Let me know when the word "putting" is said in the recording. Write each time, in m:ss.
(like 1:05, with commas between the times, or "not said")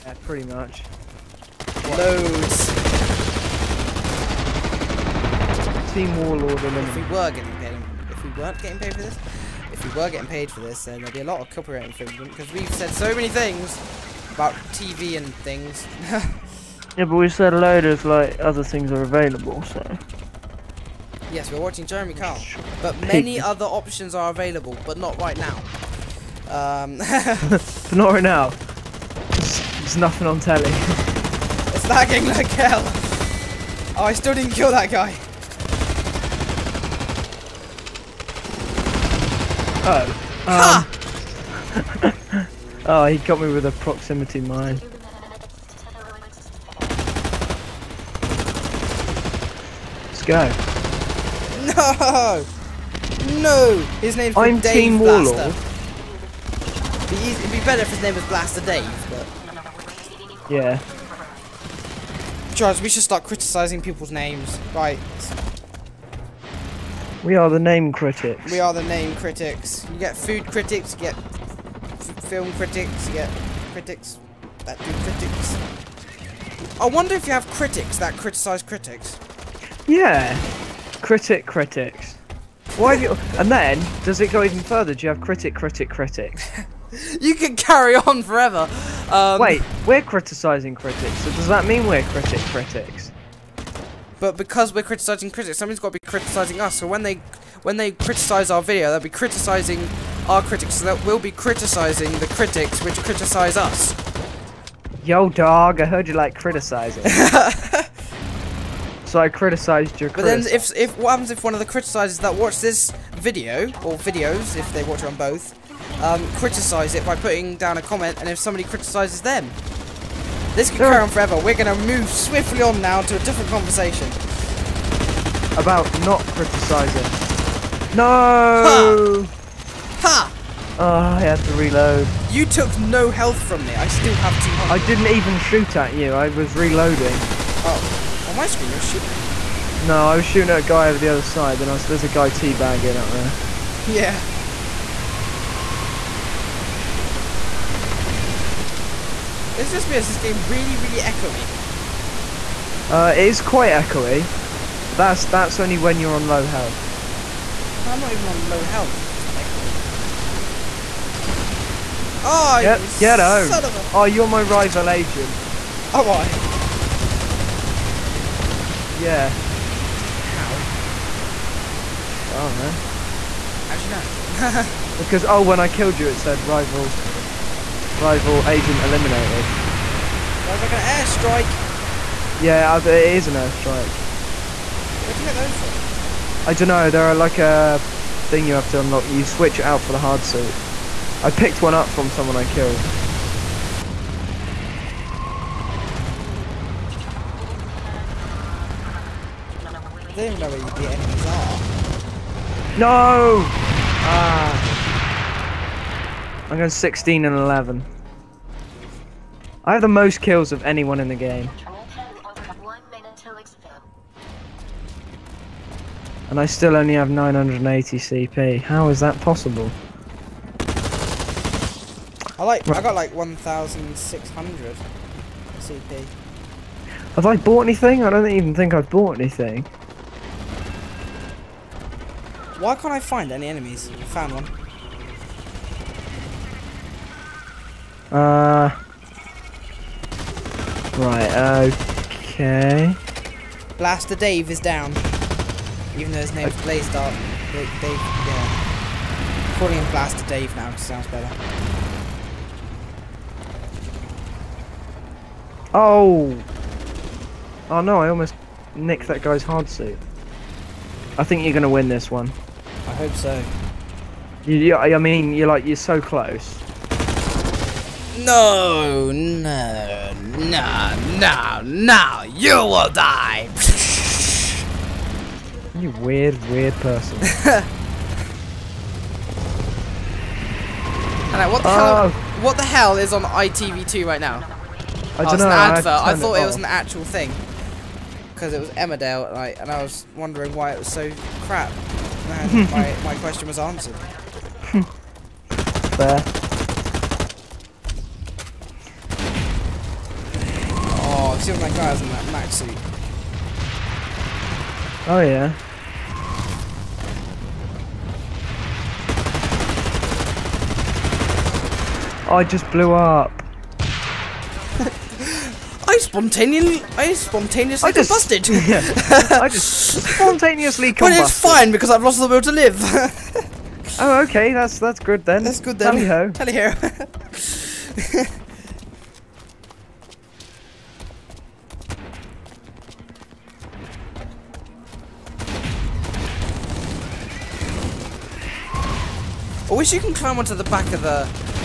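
1:57.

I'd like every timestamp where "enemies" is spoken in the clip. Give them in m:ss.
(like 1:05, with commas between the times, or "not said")
3:20, 3:53.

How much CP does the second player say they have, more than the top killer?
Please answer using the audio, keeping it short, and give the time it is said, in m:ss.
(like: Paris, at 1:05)
1,600, at 3:43.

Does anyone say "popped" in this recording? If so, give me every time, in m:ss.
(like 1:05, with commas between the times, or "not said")
not said.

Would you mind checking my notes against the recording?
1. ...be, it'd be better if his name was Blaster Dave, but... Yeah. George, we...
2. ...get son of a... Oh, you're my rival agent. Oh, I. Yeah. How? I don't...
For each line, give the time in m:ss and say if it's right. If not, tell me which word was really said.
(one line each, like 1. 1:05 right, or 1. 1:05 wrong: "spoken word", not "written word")
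1. 0:57 right
2. 2:42 right.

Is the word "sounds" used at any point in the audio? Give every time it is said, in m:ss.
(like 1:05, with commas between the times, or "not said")
4:10.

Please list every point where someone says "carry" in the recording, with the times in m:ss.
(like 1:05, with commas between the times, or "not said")
1:27, 2:00.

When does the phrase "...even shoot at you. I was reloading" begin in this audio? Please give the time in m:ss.
2:15.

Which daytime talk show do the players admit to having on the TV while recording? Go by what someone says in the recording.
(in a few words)
Jeremy Kyle.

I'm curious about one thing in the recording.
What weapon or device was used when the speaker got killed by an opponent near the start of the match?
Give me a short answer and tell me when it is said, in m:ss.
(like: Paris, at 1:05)
Proximity mine, at 0:43.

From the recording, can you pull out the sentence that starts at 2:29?
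me is this game really, really echoey.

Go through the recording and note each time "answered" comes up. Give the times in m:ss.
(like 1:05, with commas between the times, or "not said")
4:53.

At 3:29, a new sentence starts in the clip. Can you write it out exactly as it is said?
I have the most kills of anyone in the game.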